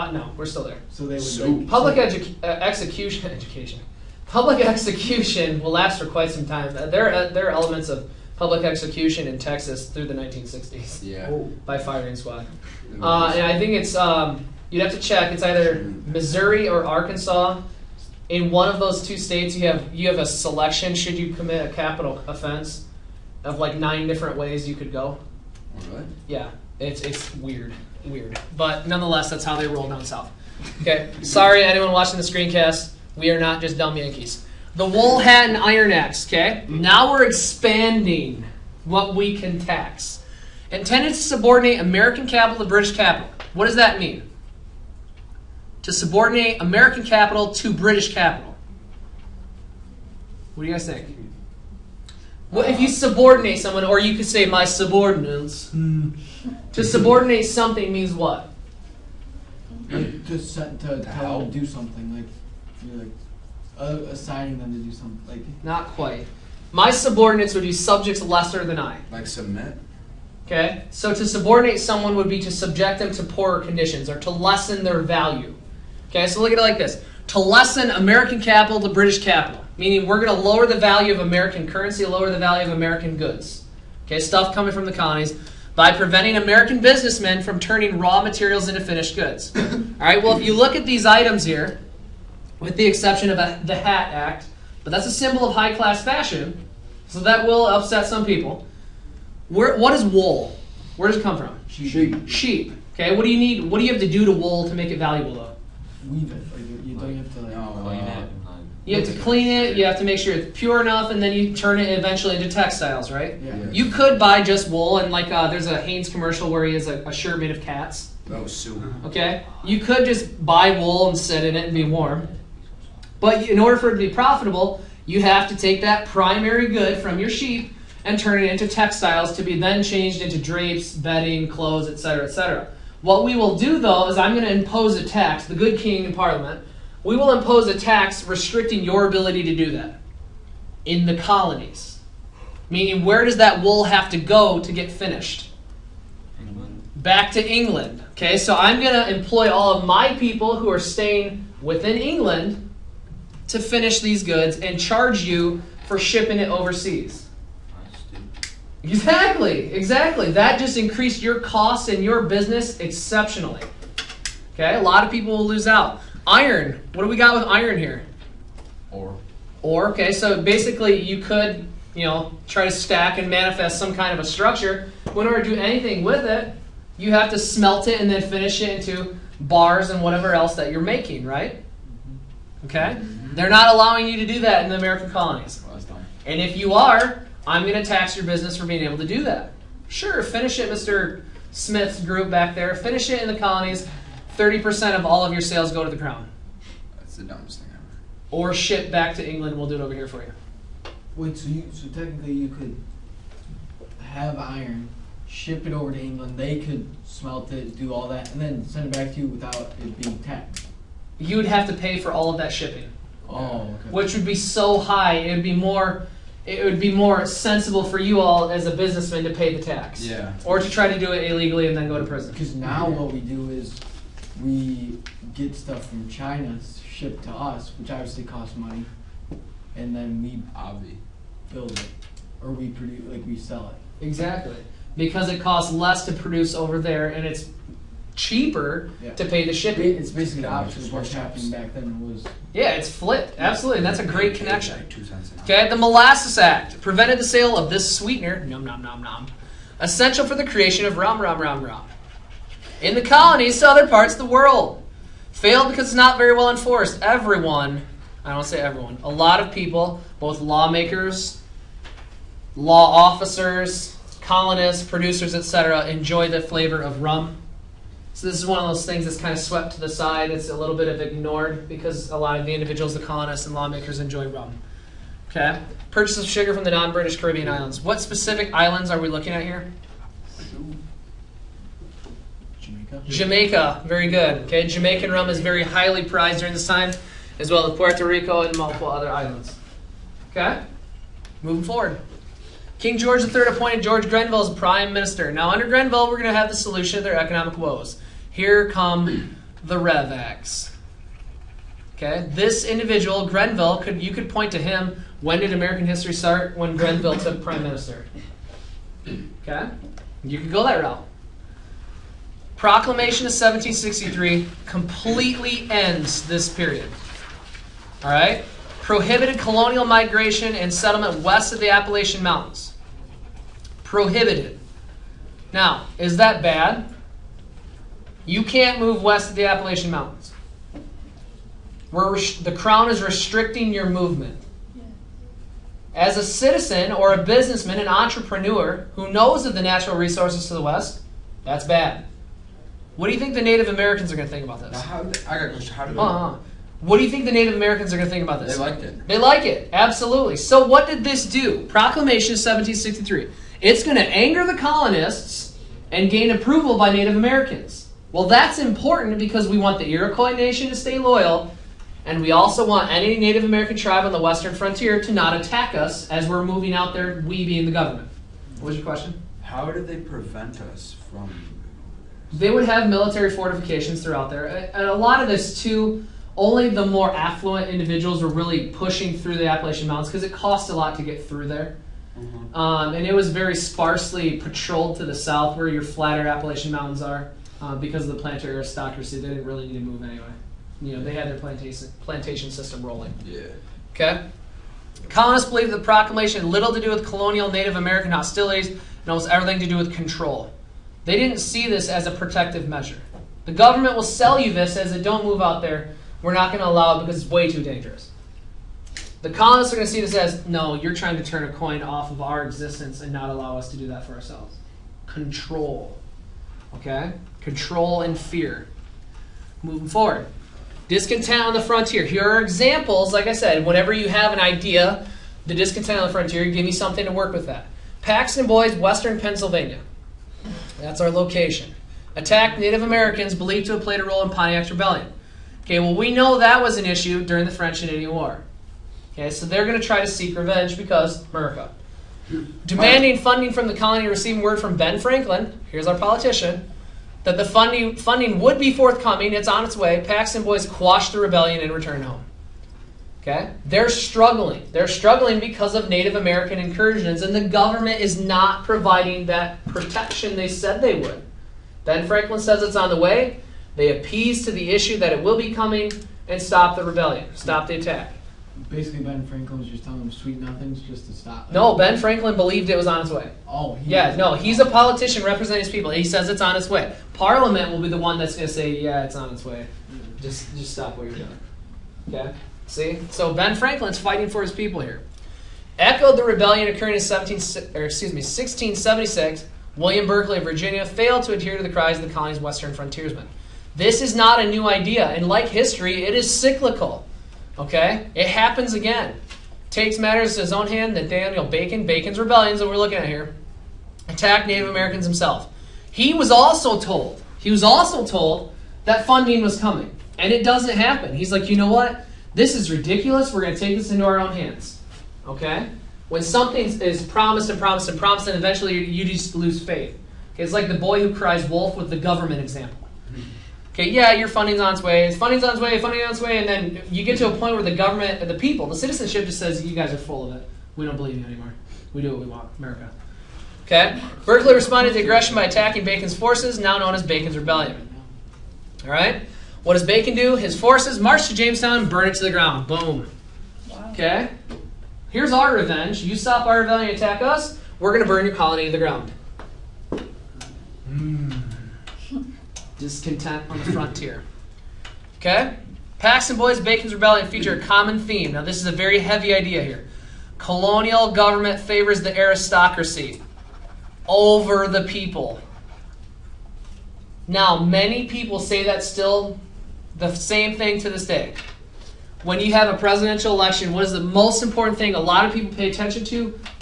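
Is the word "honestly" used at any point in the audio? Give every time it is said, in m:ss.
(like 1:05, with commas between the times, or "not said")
not said.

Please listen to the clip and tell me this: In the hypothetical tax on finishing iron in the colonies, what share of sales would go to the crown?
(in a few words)
30%.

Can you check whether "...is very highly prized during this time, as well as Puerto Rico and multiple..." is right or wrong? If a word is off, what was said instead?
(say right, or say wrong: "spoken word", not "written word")
right.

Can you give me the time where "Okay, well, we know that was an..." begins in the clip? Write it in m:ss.
7:15.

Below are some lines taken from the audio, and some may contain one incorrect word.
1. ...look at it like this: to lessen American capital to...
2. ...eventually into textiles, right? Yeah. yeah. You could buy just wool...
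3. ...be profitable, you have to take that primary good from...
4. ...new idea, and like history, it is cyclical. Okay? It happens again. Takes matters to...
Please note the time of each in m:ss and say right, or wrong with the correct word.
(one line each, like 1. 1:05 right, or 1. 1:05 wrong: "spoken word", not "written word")
1. 1:16 right
2. 1:51 right
3. 2:04 right
4. 8:14 right.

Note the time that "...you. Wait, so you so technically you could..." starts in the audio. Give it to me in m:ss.
3:20.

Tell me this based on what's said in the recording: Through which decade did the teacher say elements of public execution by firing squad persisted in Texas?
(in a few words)
1960s.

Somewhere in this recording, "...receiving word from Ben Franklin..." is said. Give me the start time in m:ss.
7:24.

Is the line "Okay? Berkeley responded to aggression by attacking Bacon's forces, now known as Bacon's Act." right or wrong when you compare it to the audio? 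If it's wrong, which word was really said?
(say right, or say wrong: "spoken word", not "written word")
wrong: "Rebellion", not "Act".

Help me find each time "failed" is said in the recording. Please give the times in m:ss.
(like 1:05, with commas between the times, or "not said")
4:15, 8:10.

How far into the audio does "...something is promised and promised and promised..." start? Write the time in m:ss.
8:36.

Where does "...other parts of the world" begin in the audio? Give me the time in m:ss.
4:13.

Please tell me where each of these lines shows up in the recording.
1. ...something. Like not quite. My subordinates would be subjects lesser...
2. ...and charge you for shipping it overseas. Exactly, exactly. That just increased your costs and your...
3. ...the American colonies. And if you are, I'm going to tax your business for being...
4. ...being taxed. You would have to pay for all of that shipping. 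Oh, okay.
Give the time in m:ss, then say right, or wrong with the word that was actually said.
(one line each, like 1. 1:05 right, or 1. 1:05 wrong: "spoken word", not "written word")
1. 1:04 right
2. 2:34 right
3. 3:04 right
4. 3:30 right.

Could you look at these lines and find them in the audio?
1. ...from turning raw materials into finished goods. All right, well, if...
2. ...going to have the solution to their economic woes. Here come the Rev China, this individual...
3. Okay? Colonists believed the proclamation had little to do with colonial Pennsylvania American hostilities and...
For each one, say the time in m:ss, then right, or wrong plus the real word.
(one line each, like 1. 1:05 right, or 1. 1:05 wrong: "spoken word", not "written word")
1. 1:27 right
2. 4:56 wrong: "Okay", not "China"
3. 6:33 wrong: "Native", not "Pennsylvania".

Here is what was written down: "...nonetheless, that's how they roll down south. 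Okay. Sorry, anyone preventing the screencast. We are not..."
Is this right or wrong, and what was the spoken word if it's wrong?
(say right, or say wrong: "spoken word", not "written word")
wrong: "watching", not "preventing".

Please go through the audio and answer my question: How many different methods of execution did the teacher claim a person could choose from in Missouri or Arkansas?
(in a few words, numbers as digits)
9.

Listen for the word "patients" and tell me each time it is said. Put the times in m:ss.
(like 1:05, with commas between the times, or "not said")
not said.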